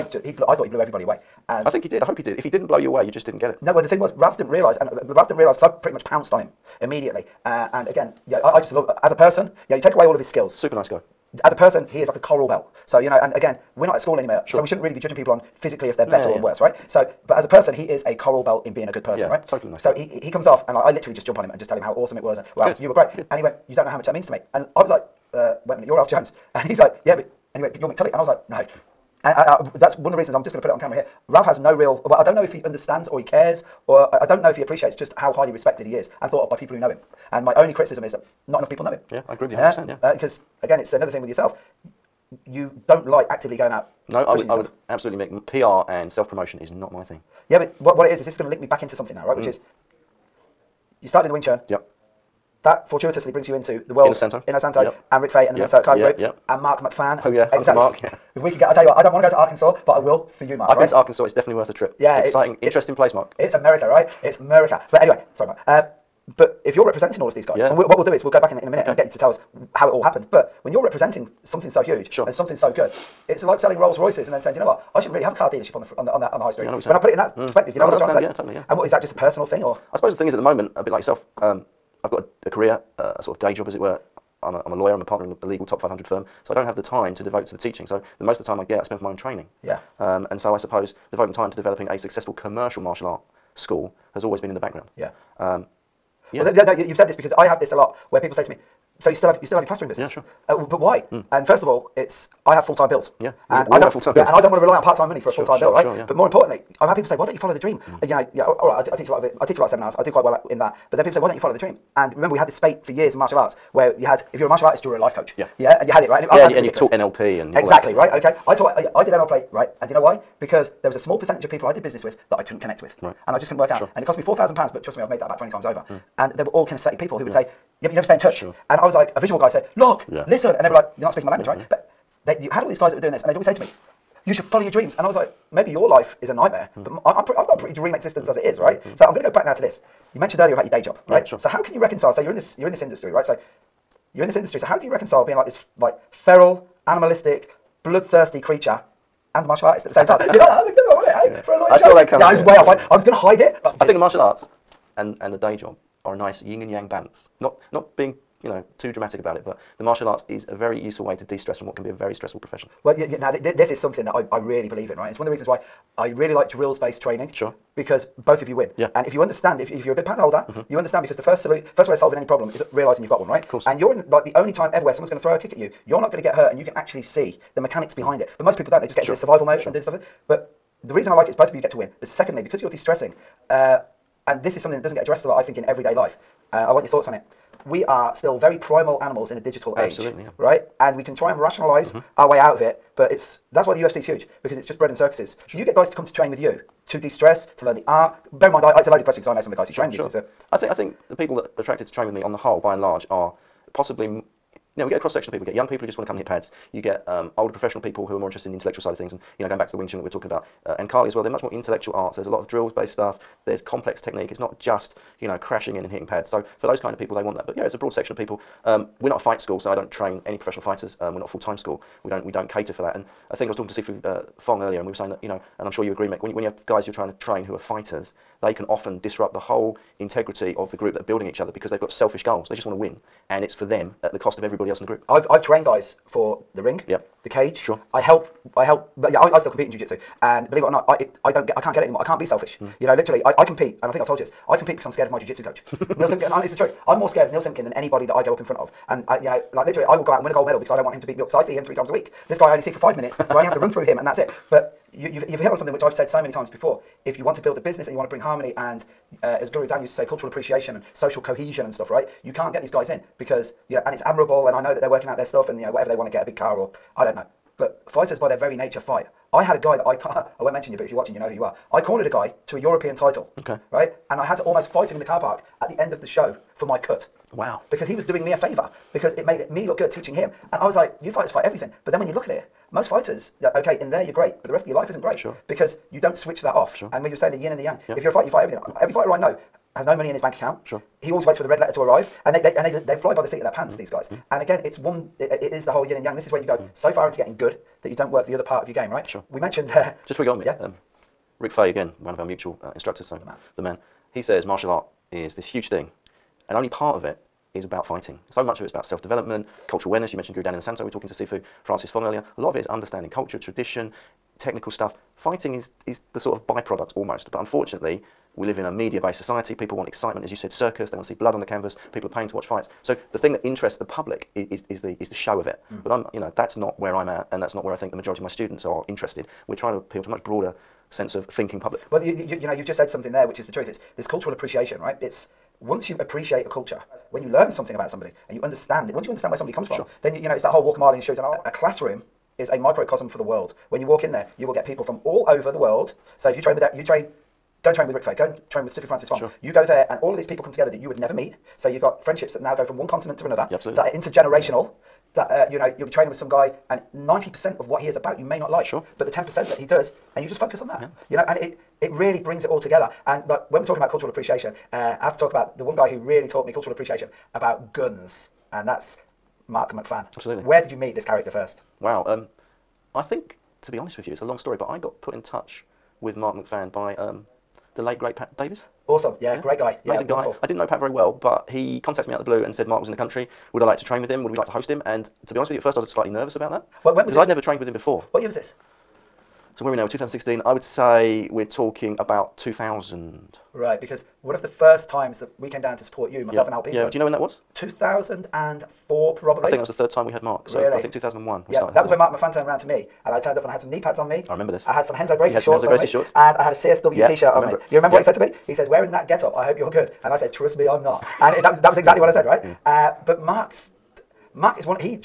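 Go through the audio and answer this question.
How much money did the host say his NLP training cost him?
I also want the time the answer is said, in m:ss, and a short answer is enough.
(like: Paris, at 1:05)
4,000 pounds, at 2:04.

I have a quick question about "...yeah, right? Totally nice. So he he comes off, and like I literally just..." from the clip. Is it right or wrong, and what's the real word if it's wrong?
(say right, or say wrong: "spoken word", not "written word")
right.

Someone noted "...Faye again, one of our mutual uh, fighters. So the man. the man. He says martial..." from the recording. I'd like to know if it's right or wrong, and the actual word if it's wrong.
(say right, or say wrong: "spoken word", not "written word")
wrong: "instructors", not "fighters".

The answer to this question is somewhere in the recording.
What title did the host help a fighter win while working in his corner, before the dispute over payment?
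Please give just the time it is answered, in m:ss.
4:32.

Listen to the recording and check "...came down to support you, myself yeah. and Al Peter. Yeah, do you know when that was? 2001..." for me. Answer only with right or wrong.
wrong.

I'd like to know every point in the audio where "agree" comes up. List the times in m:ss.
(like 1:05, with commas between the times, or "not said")
0:39, 3:45.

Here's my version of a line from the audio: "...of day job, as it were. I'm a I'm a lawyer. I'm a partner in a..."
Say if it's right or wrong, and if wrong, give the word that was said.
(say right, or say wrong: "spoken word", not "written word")
right.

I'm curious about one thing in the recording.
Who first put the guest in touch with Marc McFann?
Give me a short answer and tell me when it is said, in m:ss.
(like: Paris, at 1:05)
Pat Davis, at 6:18.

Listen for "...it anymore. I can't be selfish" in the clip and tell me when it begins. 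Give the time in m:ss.
4:01.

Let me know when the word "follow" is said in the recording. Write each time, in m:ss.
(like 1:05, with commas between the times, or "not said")
1:47, 1:51, 2:14.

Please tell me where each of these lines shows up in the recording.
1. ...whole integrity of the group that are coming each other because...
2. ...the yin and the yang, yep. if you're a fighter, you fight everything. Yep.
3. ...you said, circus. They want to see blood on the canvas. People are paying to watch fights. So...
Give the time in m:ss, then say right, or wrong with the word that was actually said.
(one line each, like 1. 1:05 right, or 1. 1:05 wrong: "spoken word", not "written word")
1. 3:49 wrong: "building", not "coming"
2. 4:47 right
3. 5:20 right.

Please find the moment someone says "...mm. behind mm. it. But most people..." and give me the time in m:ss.
2:57.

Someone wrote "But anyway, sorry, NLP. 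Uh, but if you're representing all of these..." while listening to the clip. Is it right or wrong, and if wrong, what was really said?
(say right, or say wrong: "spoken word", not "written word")
wrong: "Mark", not "NLP".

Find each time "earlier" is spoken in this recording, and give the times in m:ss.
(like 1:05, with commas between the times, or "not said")
2:20, 3:44, 5:12.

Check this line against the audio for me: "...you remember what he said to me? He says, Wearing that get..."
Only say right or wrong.
right.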